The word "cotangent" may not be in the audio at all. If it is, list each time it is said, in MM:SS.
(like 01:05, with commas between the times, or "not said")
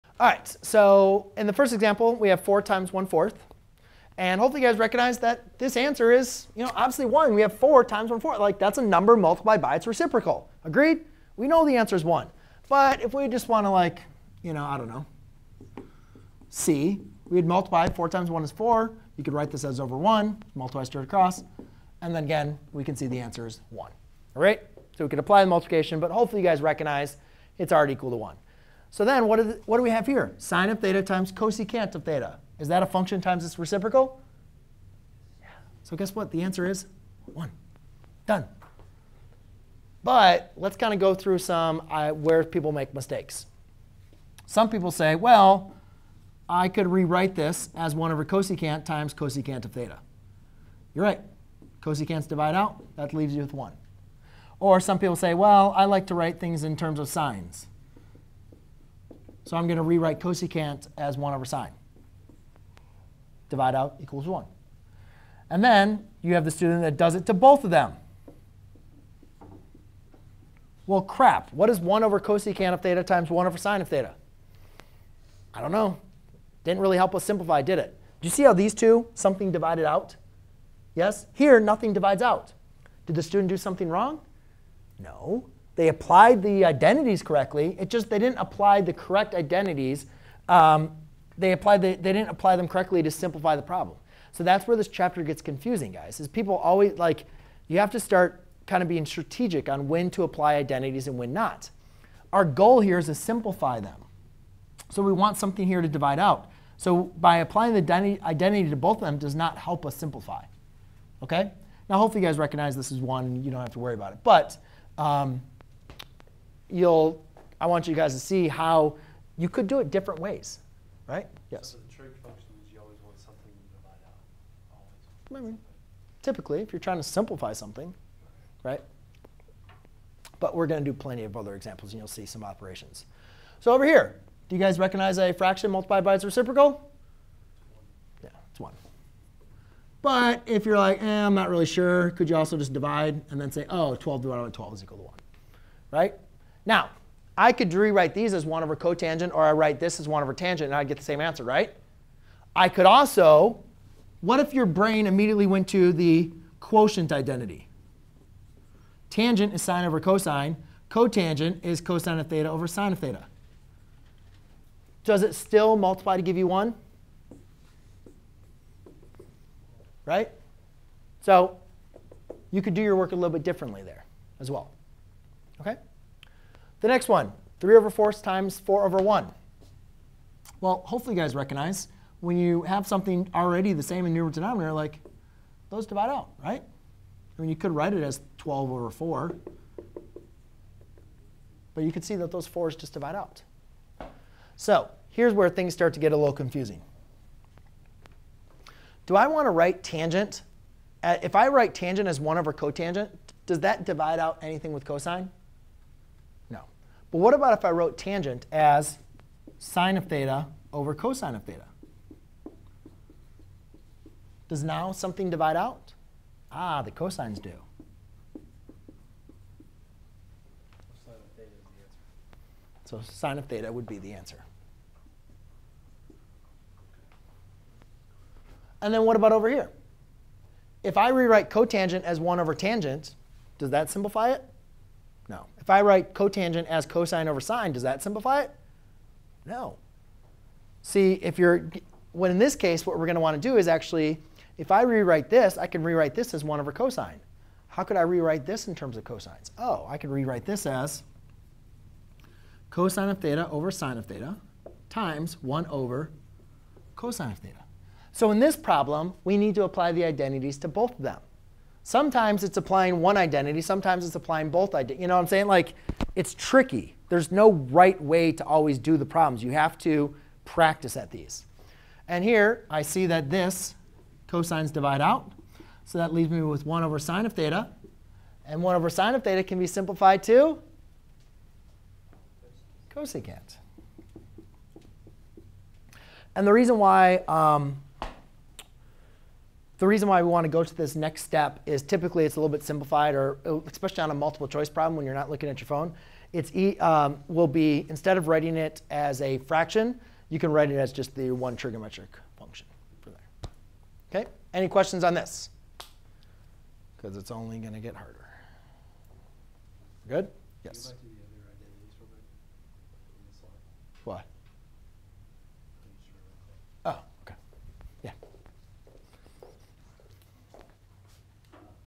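02:28, 02:40, 03:22, 03:51, 03:56.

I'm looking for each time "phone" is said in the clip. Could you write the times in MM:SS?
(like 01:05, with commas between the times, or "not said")
04:55.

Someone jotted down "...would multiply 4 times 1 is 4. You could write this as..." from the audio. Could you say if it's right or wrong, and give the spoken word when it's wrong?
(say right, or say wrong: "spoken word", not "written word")
right.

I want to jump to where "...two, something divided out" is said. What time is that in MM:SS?
01:18.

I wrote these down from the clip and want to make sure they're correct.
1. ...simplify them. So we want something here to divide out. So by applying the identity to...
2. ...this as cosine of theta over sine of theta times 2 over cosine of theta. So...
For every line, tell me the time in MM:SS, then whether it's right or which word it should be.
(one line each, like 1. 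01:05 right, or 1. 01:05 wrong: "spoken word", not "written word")
1. 01:43 right
2. 04:10 wrong: "1", not "2".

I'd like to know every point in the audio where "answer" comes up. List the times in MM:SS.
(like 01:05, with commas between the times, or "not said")
00:05, 00:11, 00:23, 00:36, 02:31, 03:44.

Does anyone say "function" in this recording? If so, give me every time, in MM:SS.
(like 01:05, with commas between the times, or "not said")
00:32, 02:02, 05:02.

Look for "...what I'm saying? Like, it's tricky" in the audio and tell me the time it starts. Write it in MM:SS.
04:25.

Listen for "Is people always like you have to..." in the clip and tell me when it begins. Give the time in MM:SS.
01:36.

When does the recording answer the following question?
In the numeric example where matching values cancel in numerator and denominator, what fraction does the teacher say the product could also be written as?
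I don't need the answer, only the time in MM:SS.
03:08.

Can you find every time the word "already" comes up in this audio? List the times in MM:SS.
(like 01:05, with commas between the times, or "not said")
00:27, 03:03.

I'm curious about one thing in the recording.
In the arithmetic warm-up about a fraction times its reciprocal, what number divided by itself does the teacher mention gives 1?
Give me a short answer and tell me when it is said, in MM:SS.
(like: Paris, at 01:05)
12, at 02:23.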